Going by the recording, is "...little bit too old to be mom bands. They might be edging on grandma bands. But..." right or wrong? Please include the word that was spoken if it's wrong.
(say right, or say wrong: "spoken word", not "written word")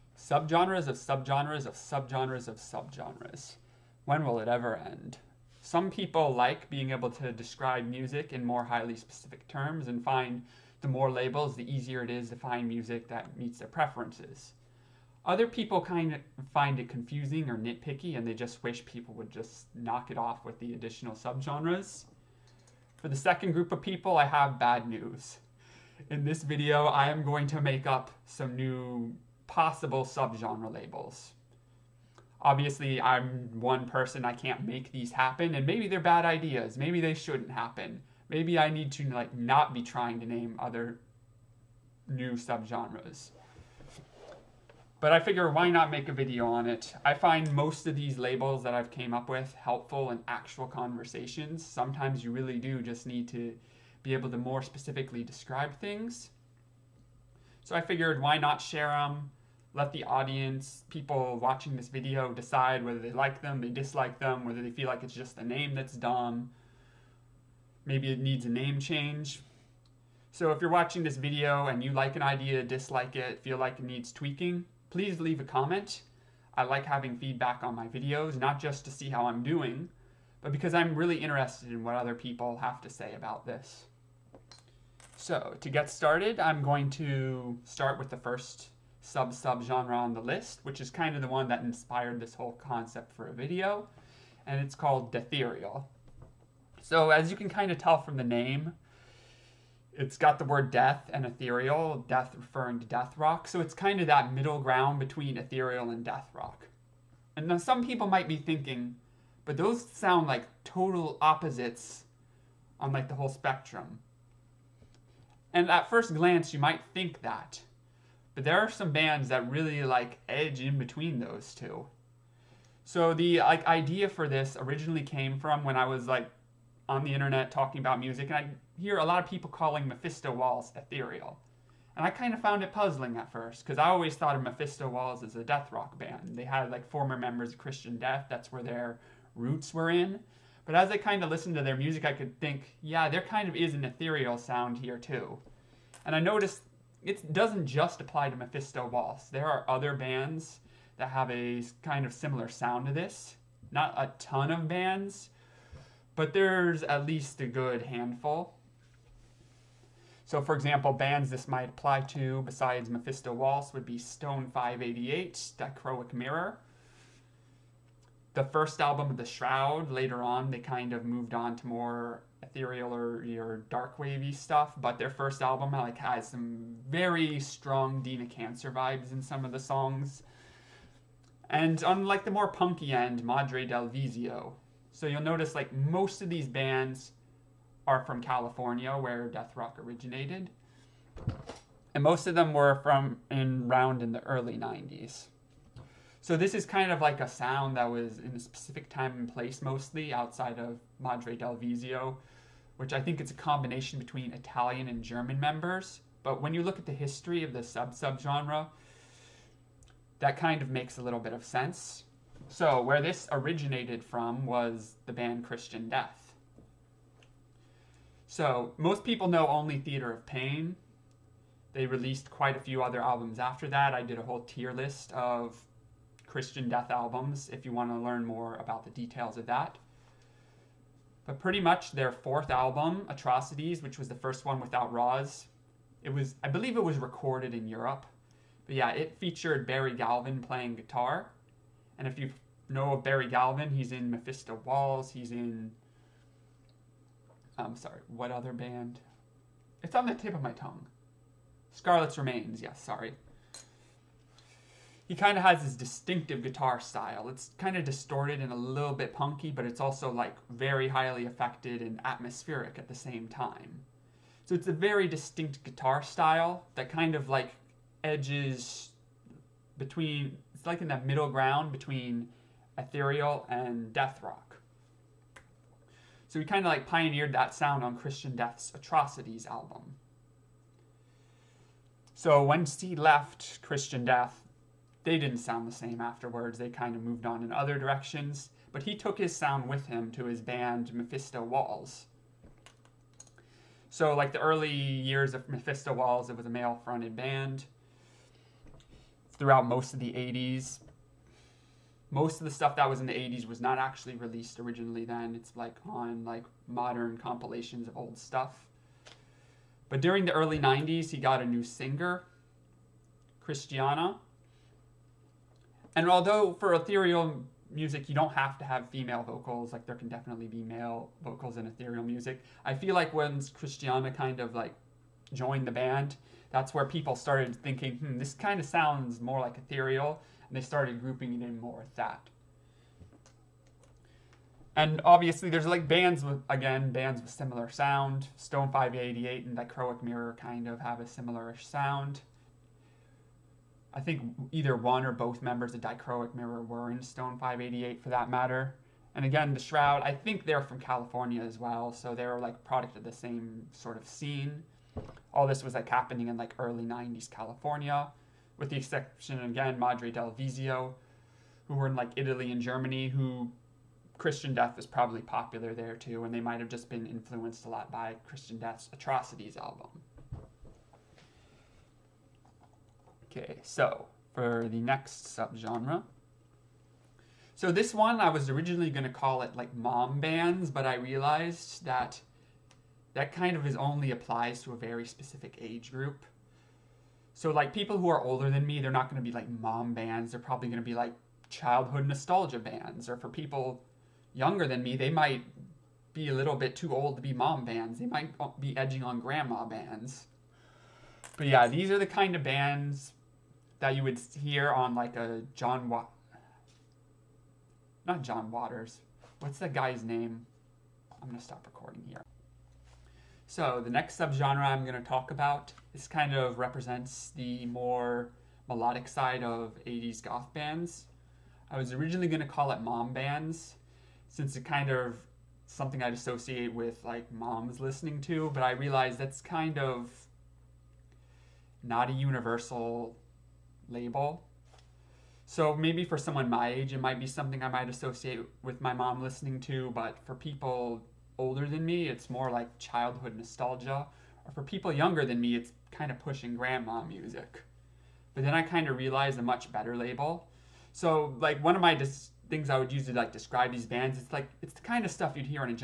right.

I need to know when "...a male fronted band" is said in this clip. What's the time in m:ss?
4:56.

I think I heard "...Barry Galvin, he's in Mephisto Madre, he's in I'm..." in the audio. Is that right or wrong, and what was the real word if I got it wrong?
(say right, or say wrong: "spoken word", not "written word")
wrong: "Waltz", not "Madre".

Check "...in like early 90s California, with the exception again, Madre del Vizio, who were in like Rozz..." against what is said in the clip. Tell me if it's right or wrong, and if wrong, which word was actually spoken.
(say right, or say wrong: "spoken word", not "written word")
wrong: "Italy", not "Rozz".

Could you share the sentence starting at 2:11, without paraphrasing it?
And I kind of found it puzzling at first because I always thought of Mephisto Waltz as a death rock band.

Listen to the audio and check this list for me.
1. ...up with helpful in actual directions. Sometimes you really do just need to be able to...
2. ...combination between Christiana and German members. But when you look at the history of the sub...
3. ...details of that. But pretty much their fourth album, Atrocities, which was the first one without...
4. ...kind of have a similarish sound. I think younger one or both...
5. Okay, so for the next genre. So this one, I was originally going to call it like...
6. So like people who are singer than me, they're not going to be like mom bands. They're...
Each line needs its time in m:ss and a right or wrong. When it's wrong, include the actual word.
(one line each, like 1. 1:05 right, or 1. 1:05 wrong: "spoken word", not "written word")
1. 0:49 wrong: "conversations", not "directions"
2. 3:23 wrong: "Italian", not "Christiana"
3. 3:48 right
4. 5:40 wrong: "either", not "younger"
5. 6:13 wrong: "subgenre", not "genre"
6. 6:27 wrong: "older", not "singer".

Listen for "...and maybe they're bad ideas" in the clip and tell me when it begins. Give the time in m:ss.
0:35.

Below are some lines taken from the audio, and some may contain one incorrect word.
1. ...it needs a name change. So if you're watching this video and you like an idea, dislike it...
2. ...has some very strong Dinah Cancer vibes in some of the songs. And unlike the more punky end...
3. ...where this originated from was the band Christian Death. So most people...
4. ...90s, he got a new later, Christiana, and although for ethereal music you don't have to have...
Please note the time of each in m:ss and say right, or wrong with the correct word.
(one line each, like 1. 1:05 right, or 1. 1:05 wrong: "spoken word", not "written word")
1. 1:08 right
2. 2:55 right
3. 3:32 right
4. 5:10 wrong: "singer", not "later".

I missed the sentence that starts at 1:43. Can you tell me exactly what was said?
So, it's kind of that middle ground between ethereal and death rock.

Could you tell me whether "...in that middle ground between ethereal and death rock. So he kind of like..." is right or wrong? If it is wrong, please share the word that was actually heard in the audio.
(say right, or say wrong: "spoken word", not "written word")
right.